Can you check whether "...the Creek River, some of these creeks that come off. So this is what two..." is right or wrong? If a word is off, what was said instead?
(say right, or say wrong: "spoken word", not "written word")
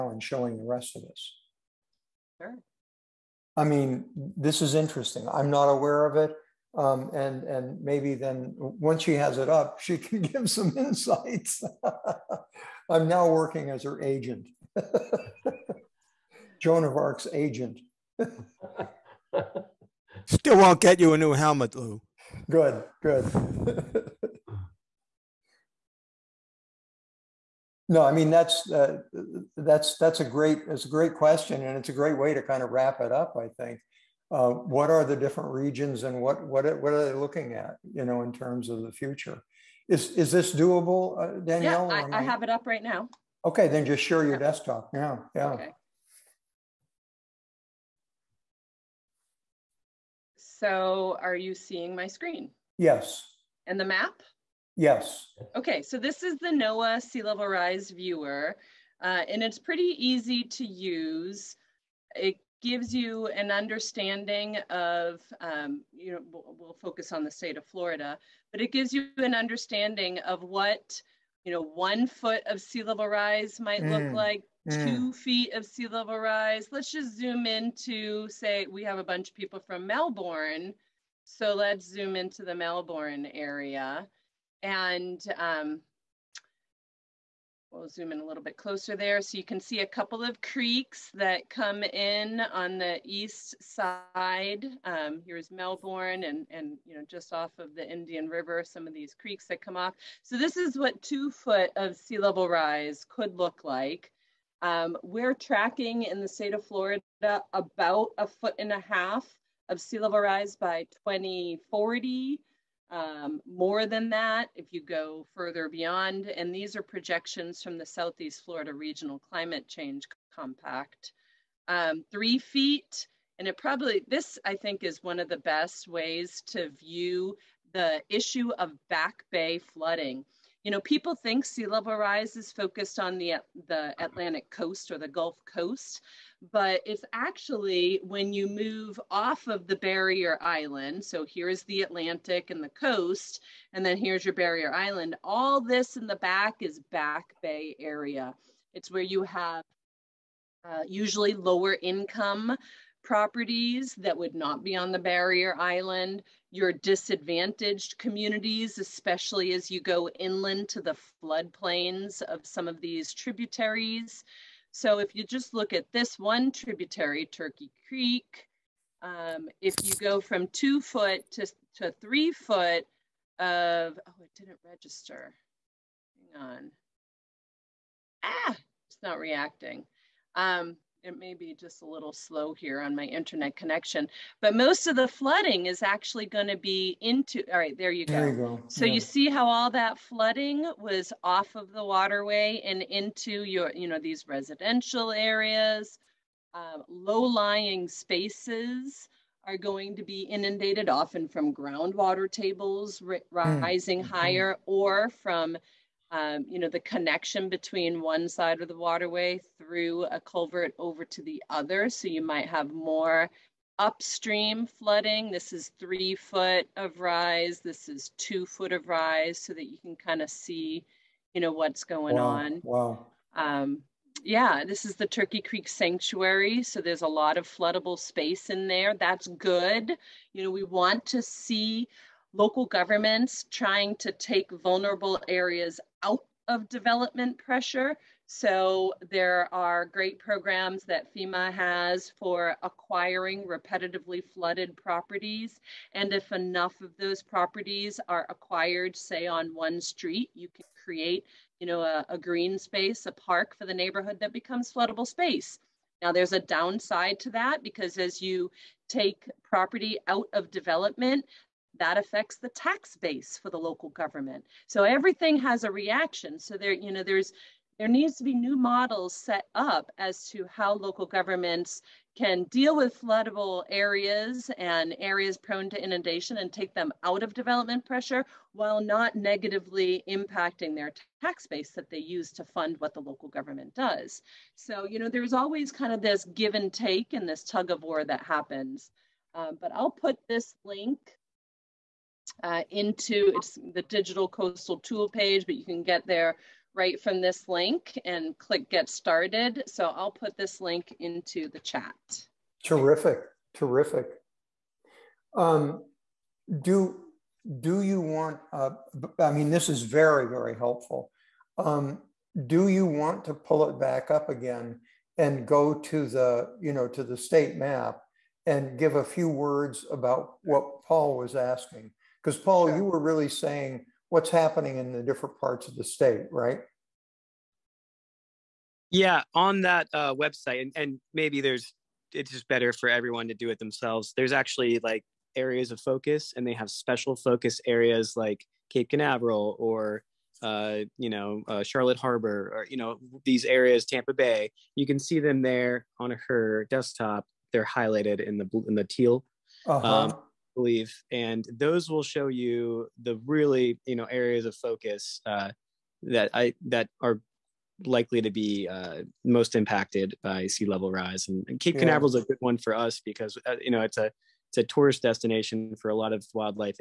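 wrong: "Indian", not "Creek".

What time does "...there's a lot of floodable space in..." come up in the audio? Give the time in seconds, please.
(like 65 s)
226 s.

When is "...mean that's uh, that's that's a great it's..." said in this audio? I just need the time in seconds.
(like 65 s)
28 s.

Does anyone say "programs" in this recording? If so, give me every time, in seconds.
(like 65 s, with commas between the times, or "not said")
240 s.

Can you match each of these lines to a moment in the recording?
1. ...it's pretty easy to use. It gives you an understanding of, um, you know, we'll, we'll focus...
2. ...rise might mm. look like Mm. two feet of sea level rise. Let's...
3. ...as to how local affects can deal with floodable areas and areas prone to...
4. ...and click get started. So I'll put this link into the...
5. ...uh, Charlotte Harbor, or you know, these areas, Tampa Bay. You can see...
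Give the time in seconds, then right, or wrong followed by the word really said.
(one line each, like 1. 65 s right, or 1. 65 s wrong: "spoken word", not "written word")
1. 59 s right
2. 73 s right
3. 269 s wrong: "governments", not "affects"
4. 298 s right
5. 341 s right.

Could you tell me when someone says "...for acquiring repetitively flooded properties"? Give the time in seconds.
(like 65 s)
242 s.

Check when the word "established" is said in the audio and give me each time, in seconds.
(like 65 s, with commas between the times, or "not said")
not said.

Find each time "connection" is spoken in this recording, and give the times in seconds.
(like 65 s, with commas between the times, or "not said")
183 s, 206 s.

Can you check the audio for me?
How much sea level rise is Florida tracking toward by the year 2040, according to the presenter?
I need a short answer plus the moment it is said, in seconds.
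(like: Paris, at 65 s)
a foot and a half, at 108 s.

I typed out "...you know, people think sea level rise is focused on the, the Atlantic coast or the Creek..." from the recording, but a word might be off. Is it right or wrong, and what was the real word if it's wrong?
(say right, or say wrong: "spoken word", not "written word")
wrong: "Gulf", not "Creek".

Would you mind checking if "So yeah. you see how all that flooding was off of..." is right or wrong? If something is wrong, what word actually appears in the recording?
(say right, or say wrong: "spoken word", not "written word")
right.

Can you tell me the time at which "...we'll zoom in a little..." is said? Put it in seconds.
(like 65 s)
87 s.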